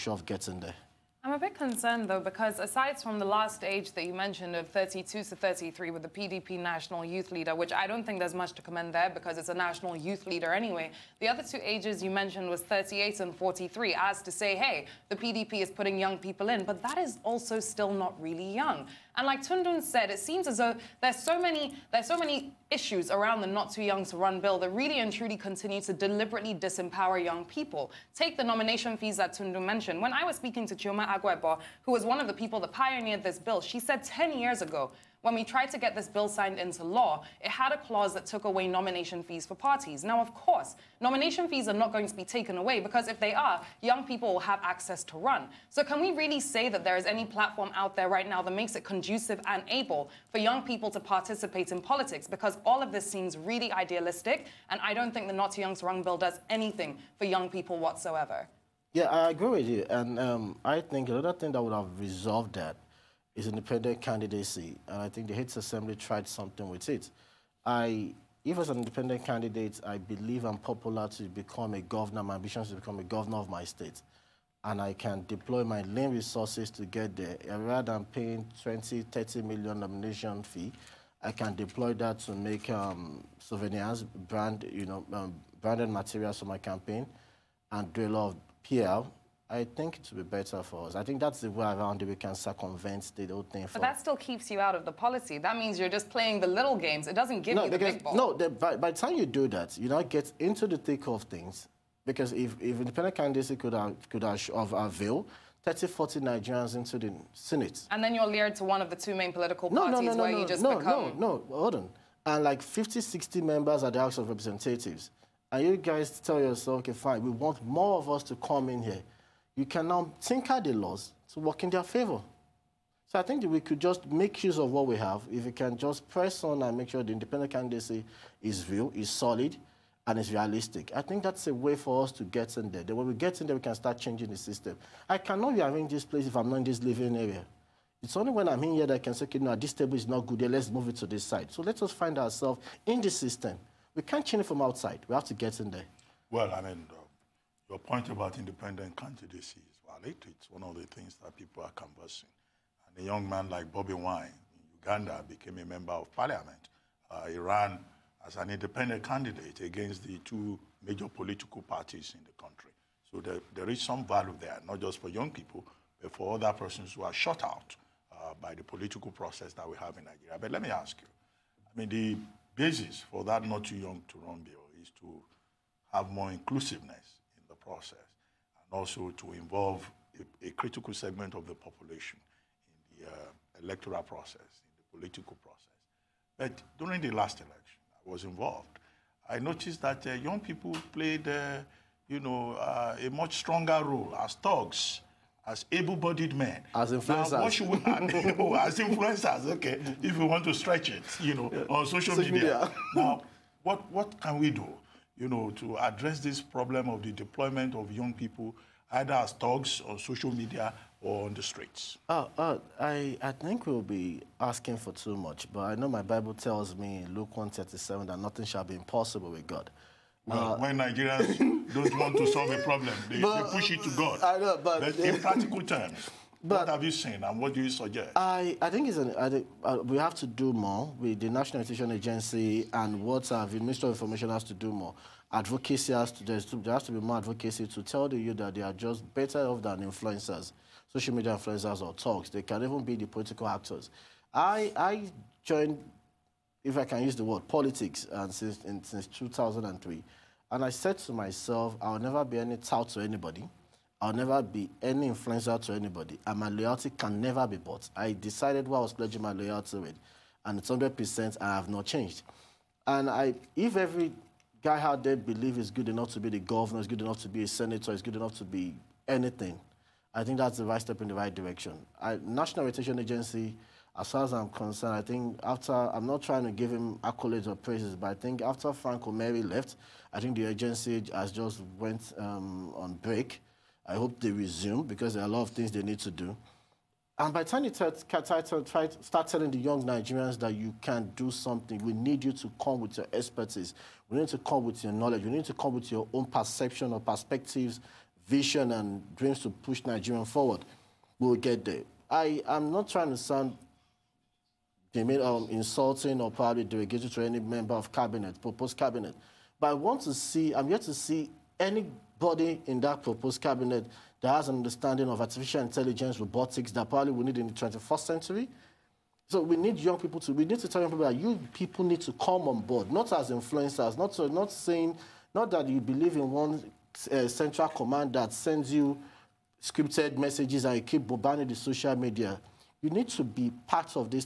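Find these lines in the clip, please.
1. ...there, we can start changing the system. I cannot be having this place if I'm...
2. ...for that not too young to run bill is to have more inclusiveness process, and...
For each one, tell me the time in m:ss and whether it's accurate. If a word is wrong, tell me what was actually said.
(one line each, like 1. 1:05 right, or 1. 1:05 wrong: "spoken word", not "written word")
1. 2:13 right
2. 2:53 right.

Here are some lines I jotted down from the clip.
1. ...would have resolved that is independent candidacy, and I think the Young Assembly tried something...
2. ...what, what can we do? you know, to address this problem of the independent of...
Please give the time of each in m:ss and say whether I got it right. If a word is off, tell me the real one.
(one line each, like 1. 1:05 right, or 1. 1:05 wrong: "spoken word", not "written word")
1. 1:01 wrong: "Hits", not "Young"
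2. 3:23 wrong: "deployment", not "independent".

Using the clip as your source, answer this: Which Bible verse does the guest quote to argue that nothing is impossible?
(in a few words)
Luke 1:37.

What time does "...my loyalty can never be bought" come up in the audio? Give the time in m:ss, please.
4:16.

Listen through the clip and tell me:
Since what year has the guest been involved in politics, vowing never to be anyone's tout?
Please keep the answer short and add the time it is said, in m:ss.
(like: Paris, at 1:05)
2003, at 4:09.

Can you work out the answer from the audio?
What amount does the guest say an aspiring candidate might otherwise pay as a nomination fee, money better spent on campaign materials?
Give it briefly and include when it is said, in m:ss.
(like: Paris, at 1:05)
20, 30 million, at 1:18.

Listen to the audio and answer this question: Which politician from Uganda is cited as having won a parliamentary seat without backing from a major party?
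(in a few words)
Bobby Wine.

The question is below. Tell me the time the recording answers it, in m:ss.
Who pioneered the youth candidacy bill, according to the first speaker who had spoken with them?
0:30.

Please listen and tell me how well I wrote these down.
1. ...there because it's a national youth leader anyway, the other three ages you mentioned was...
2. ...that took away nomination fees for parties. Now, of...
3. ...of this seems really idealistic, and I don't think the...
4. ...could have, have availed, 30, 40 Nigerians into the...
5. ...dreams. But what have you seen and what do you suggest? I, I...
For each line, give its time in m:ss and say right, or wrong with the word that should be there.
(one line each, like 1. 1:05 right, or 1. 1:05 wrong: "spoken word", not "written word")
1. 0:08 wrong: "two", not "three"
2. 0:38 right
3. 0:52 right
4. 1:44 right
5. 3:45 wrong: "terms", not "dreams".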